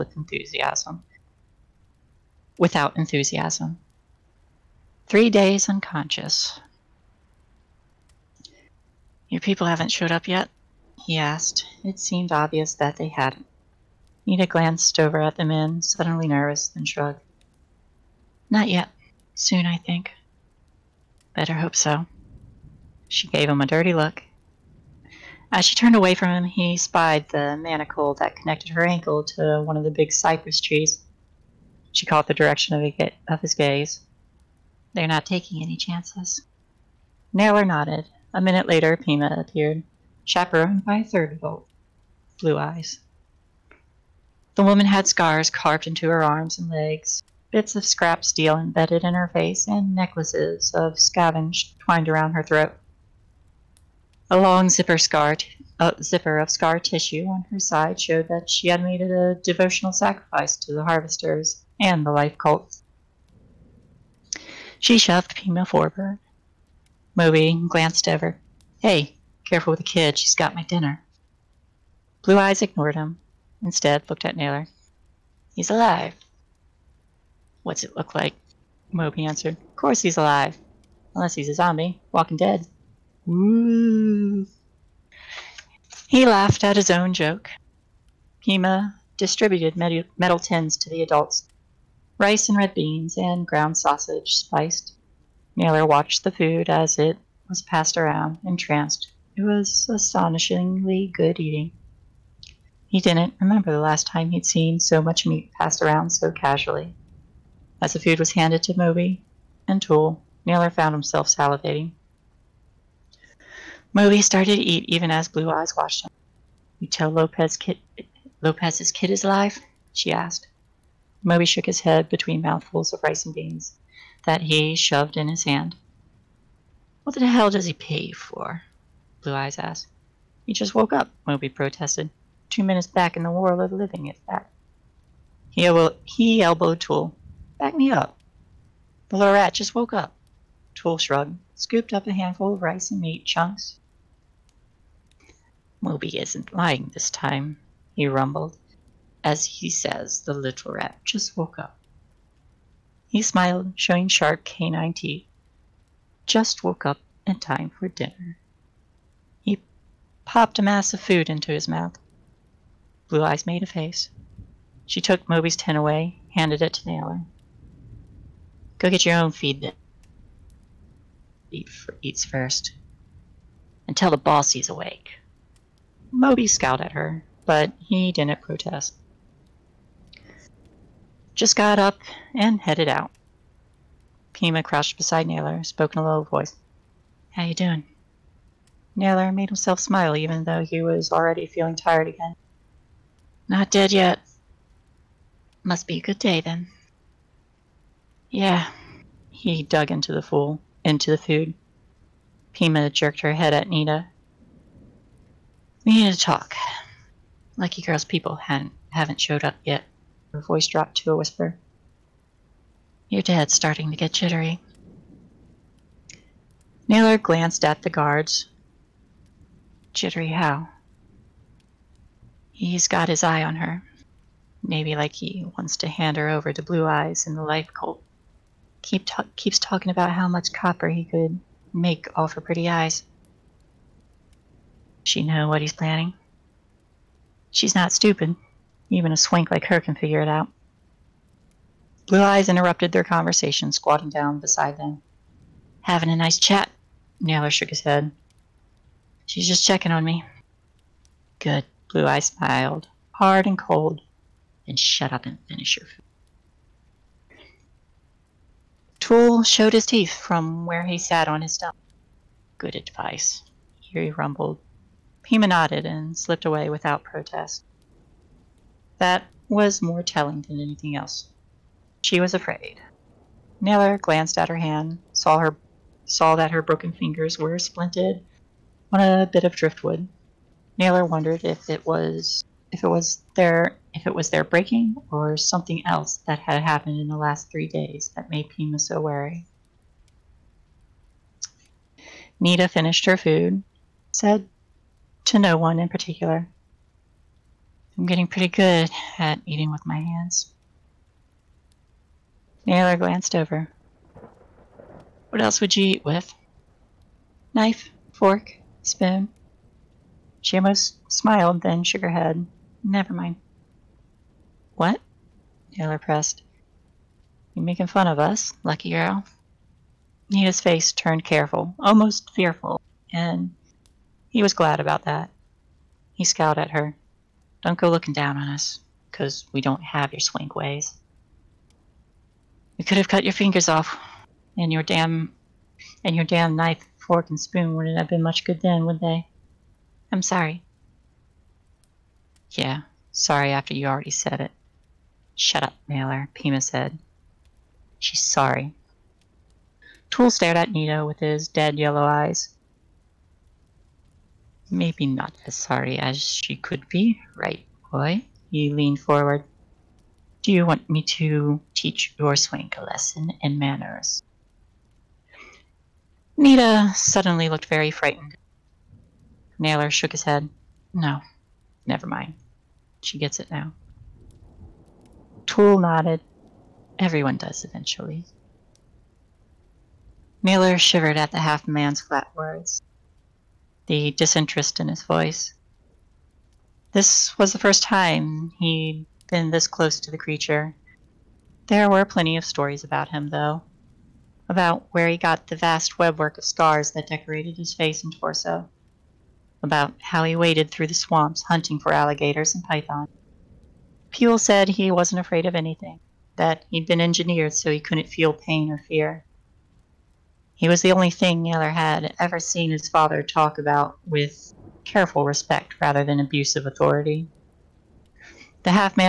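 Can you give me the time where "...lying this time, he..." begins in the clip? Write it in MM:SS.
02:26.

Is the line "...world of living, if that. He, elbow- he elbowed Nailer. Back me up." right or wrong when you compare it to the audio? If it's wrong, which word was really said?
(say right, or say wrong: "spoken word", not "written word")
wrong: "Tool", not "Nailer".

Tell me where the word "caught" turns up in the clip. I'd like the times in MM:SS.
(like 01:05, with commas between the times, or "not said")
00:32.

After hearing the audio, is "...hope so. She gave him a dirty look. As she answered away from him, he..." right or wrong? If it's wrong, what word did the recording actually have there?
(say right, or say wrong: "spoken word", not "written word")
wrong: "turned", not "answered".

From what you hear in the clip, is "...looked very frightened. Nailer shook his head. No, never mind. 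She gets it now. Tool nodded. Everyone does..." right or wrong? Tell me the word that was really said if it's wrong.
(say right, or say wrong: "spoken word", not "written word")
right.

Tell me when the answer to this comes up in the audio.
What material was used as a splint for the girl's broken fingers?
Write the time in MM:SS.
04:39.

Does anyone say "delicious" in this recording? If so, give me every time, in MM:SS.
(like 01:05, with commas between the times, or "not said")
not said.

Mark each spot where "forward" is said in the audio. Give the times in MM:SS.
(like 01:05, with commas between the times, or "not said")
01:05, 05:58.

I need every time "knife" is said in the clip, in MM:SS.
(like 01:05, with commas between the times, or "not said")
05:07, 05:36.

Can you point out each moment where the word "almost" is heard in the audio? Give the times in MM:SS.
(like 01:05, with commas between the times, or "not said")
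05:10, 05:21.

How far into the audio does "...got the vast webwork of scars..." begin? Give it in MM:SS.
06:35.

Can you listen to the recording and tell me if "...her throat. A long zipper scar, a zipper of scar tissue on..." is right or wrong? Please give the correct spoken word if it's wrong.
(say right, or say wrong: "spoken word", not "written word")
right.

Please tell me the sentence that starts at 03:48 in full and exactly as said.
Keep ta keeps talking about how much copper he could make off her pretty eyes.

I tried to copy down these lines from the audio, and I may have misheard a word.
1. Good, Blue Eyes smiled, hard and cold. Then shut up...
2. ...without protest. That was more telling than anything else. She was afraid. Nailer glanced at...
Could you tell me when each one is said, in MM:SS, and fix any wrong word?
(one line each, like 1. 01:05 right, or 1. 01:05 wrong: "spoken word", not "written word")
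1. 04:11 right
2. 04:26 right.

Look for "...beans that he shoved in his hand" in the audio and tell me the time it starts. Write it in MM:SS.
02:03.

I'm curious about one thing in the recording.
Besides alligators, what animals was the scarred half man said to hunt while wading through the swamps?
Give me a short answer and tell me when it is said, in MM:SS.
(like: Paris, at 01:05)
pythons, at 06:42.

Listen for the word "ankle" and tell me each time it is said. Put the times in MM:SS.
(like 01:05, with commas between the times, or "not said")
00:28.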